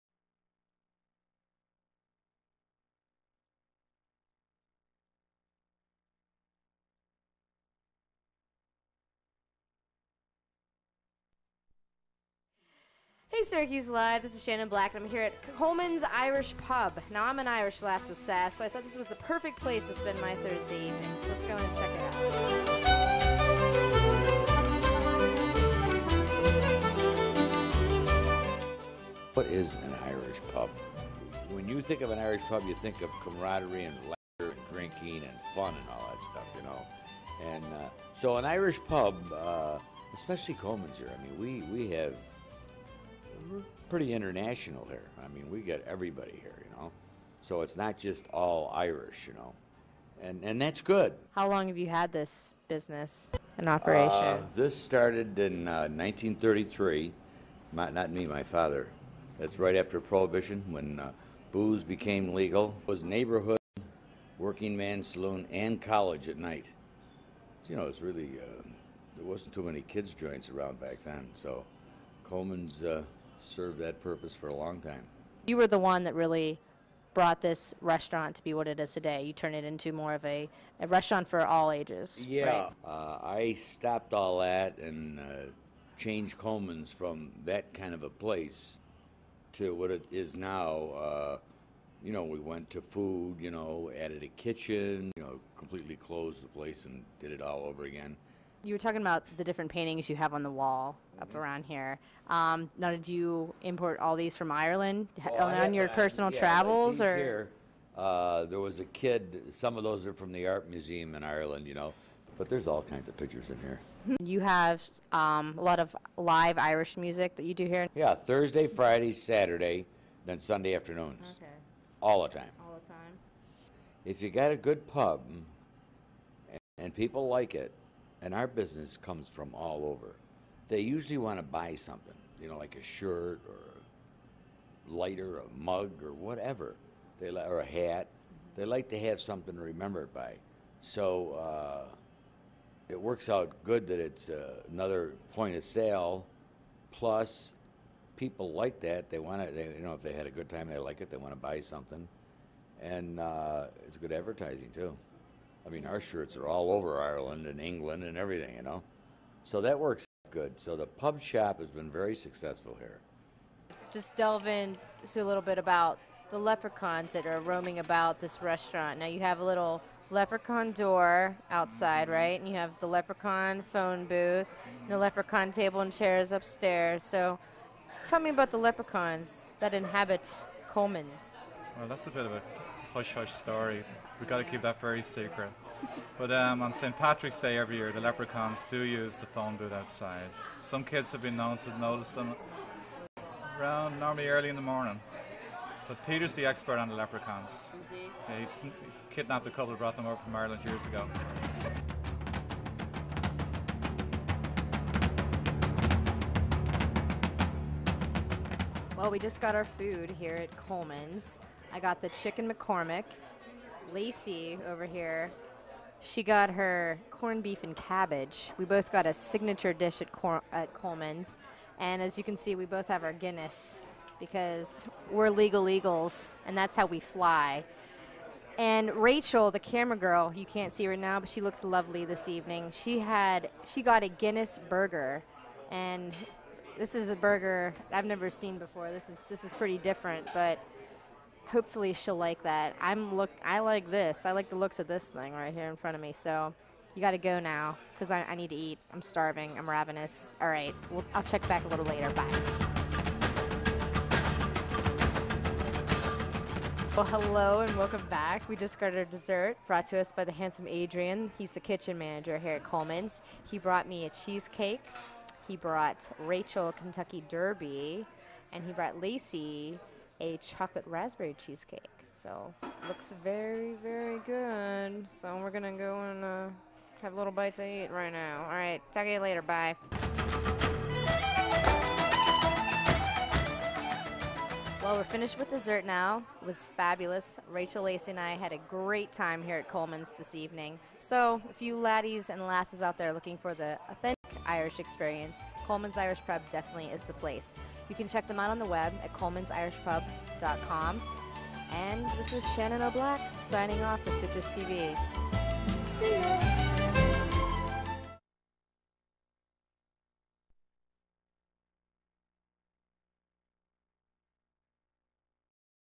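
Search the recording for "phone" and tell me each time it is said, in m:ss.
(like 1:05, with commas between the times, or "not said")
2:53, 3:09.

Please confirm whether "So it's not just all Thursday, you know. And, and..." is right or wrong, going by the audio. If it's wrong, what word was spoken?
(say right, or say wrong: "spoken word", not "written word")
wrong: "Irish", not "Thursday".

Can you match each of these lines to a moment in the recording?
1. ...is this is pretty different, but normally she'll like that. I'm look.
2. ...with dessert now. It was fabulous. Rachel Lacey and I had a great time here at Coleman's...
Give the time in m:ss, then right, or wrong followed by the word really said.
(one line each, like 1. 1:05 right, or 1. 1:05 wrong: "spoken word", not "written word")
1. 3:59 wrong: "hopefully", not "normally"
2. 4:45 right.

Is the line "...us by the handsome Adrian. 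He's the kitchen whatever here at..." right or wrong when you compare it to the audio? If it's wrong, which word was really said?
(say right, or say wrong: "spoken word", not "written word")
wrong: "manager", not "whatever".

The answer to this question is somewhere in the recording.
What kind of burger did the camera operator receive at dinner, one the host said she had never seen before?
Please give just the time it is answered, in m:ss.
3:54.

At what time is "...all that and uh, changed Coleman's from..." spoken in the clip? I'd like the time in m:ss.
1:24.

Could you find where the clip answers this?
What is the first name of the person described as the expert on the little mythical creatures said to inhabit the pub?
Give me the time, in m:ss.
3:16.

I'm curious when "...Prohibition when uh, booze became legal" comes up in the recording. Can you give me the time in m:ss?
0:59.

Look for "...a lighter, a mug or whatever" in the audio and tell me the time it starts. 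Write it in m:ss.
2:14.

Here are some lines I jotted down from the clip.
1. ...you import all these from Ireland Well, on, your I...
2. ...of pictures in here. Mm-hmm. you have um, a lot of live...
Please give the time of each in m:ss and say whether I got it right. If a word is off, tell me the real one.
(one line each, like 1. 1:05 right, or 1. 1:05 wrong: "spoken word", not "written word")
1. 1:43 right
2. 1:53 right.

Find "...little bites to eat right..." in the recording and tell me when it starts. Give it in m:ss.
4:37.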